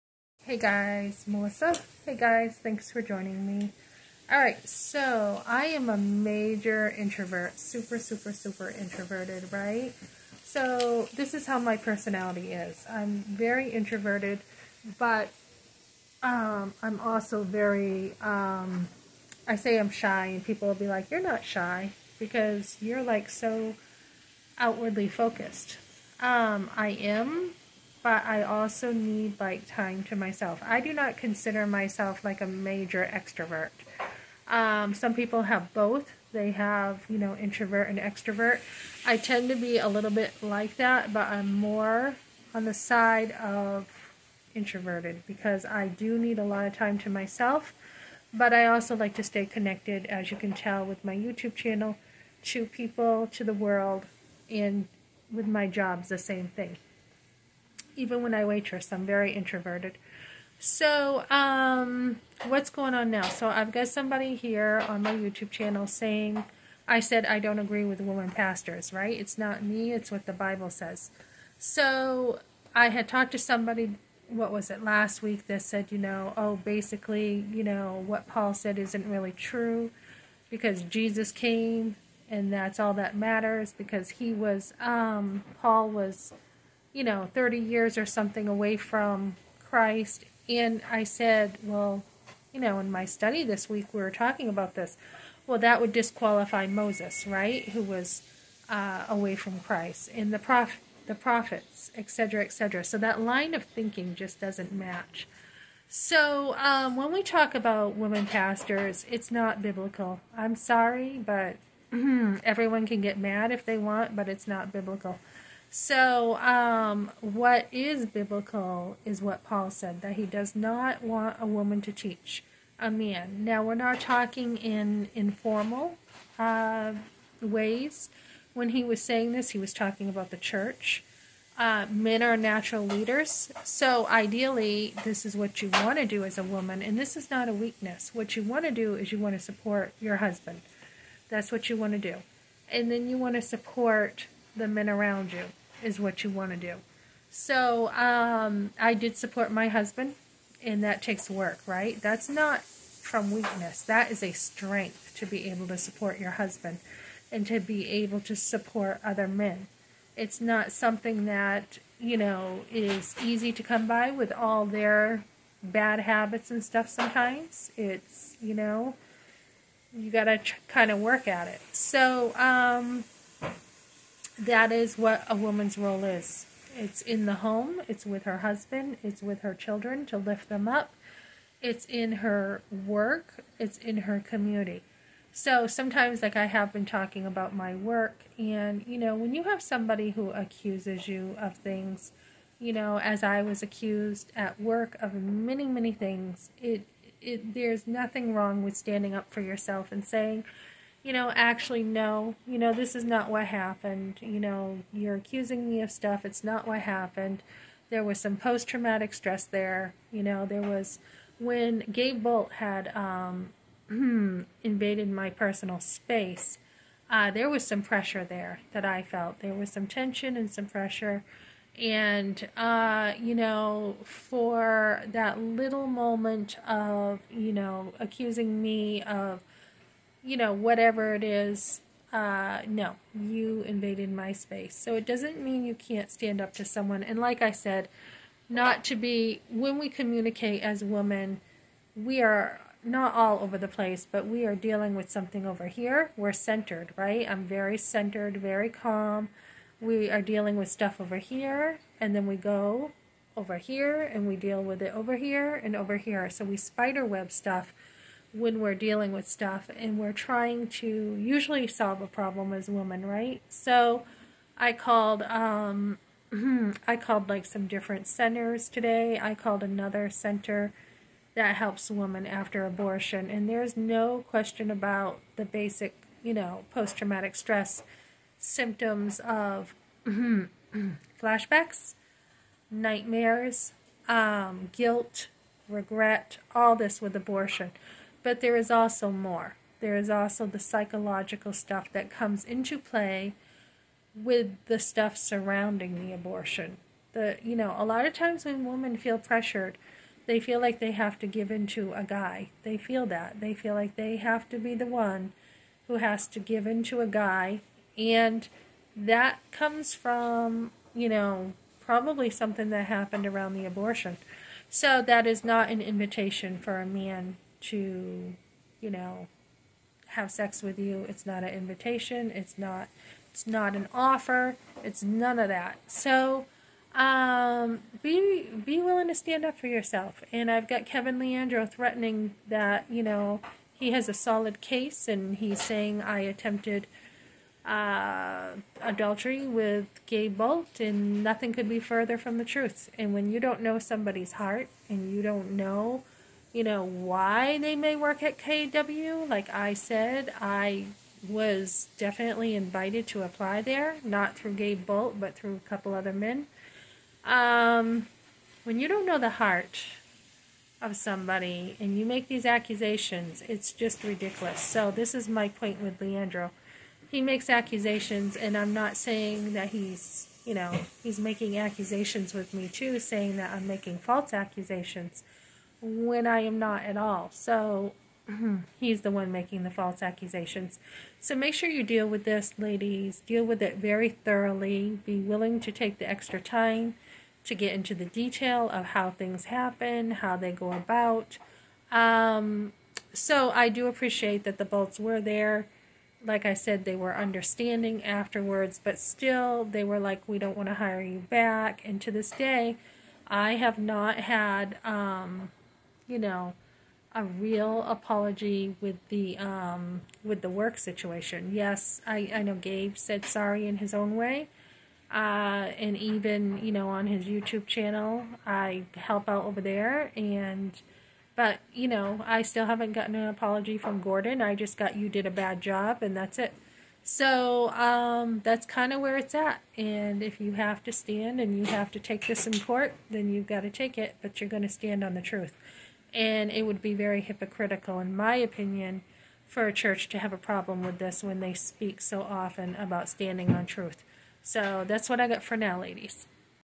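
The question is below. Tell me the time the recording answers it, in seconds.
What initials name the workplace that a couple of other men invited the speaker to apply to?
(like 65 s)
348 s.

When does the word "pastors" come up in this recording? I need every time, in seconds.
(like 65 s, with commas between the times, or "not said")
68 s, 108 s.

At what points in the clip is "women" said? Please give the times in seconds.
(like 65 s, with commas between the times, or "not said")
68 s, 107 s, 240 s, 262 s, 271 s, 298 s.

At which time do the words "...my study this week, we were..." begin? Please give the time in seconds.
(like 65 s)
92 s.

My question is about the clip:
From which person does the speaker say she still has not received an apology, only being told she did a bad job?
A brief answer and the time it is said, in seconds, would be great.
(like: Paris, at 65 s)
Gordon, at 424 s.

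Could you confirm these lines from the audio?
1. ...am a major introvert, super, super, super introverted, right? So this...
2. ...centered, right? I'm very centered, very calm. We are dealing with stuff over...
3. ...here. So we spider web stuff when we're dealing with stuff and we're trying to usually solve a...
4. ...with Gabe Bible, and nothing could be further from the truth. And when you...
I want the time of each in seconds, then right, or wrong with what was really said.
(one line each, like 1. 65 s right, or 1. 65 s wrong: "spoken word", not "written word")
1. 5 s right
2. 246 s right
3. 255 s right
4. 339 s wrong: "Bolt", not "Bible".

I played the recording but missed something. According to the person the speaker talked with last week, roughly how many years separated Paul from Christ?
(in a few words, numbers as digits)
30.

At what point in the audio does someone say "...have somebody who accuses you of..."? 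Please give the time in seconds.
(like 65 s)
189 s.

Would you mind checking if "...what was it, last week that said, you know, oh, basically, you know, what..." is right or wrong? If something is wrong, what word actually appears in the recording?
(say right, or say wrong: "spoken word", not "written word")
right.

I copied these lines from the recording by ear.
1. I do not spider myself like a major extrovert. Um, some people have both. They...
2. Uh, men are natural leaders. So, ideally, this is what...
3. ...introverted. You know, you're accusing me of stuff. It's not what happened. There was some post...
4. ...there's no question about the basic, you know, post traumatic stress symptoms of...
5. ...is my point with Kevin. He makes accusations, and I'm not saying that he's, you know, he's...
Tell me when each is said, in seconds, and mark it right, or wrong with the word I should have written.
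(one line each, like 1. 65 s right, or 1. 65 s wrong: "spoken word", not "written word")
1. 30 s wrong: "consider", not "spider"
2. 131 s right
3. 203 s wrong: "happened", not "introverted"
4. 273 s right
5. 365 s wrong: "Leandro", not "Kevin".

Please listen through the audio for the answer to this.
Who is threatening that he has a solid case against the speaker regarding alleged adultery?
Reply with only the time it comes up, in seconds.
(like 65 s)
330 s.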